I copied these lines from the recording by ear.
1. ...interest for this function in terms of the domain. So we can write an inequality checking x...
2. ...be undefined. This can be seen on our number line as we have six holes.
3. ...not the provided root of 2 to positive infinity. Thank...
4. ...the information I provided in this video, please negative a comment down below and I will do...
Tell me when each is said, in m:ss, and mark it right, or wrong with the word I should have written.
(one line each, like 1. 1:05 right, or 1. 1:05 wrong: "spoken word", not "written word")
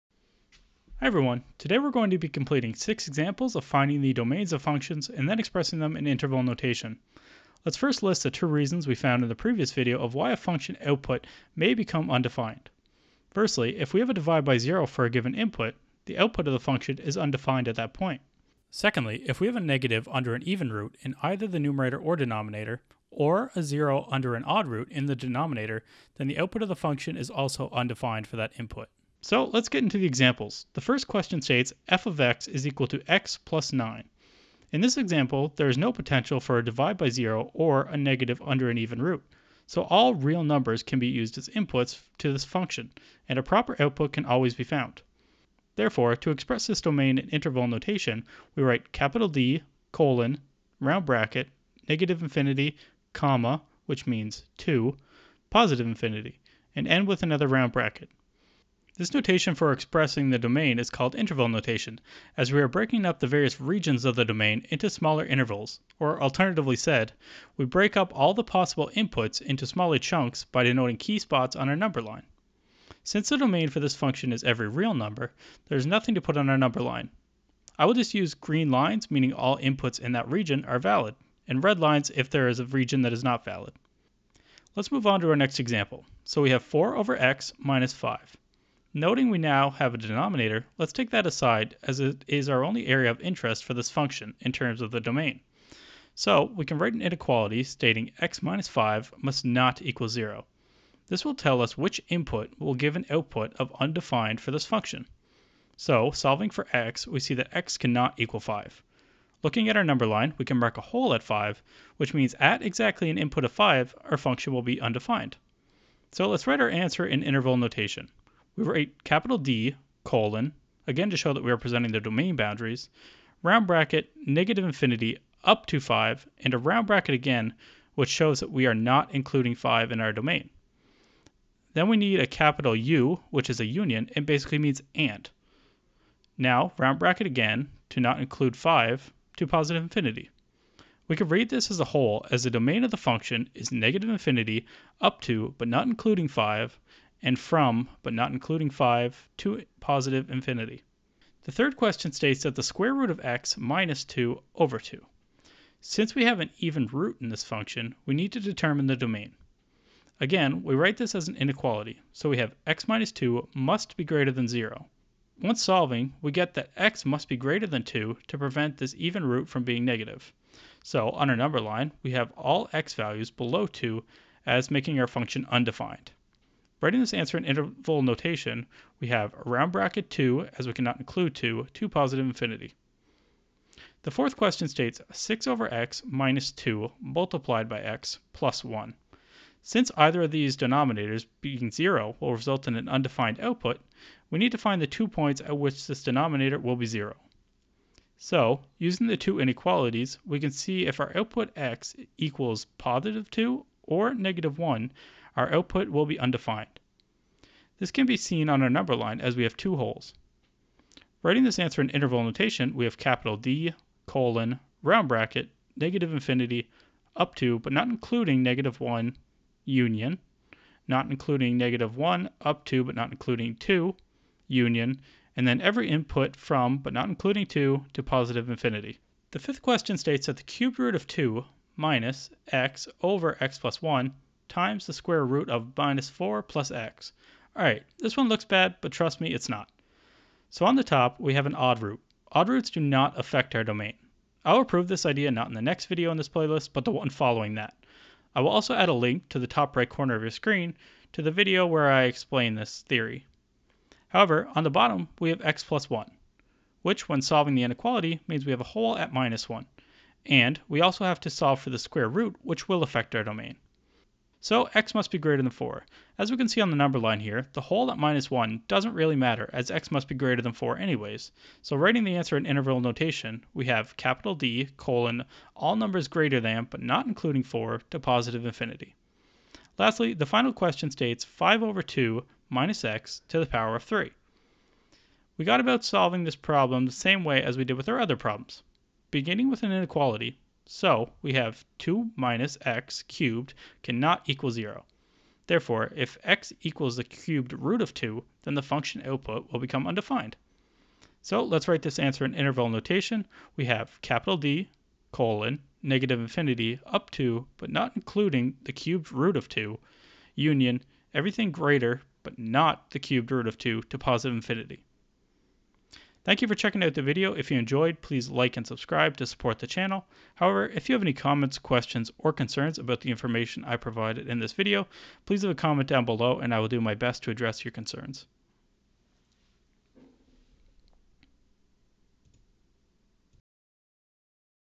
1. 1:33 wrong: "stating", not "checking"
2. 3:26 wrong: "two", not "six"
3. 5:12 wrong: "cubed", not "provided"
4. 5:23 wrong: "leave", not "negative".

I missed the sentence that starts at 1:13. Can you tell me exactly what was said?
Since the domain for this function is every real number, there's nothing to put on our number line.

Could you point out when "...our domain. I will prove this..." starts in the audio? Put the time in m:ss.
4:03.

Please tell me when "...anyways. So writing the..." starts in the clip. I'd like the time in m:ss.
4:30.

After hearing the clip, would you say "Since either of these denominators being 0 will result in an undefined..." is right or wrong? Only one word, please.
right.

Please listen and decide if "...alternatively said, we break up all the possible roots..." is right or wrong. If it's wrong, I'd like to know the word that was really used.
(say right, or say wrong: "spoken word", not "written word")
wrong: "inputs", not "roots".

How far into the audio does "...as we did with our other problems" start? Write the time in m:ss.
4:47.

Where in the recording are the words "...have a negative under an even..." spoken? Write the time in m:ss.
0:19.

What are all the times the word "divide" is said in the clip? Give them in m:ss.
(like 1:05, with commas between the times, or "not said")
0:14, 0:36.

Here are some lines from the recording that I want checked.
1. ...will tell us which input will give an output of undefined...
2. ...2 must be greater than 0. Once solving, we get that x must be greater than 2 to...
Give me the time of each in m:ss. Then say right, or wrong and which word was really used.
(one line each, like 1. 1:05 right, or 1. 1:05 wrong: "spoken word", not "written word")
1. 1:41 right
2. 2:43 right.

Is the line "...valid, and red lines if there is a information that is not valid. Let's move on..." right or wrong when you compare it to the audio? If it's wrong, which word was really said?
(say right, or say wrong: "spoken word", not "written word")
wrong: "region", not "information".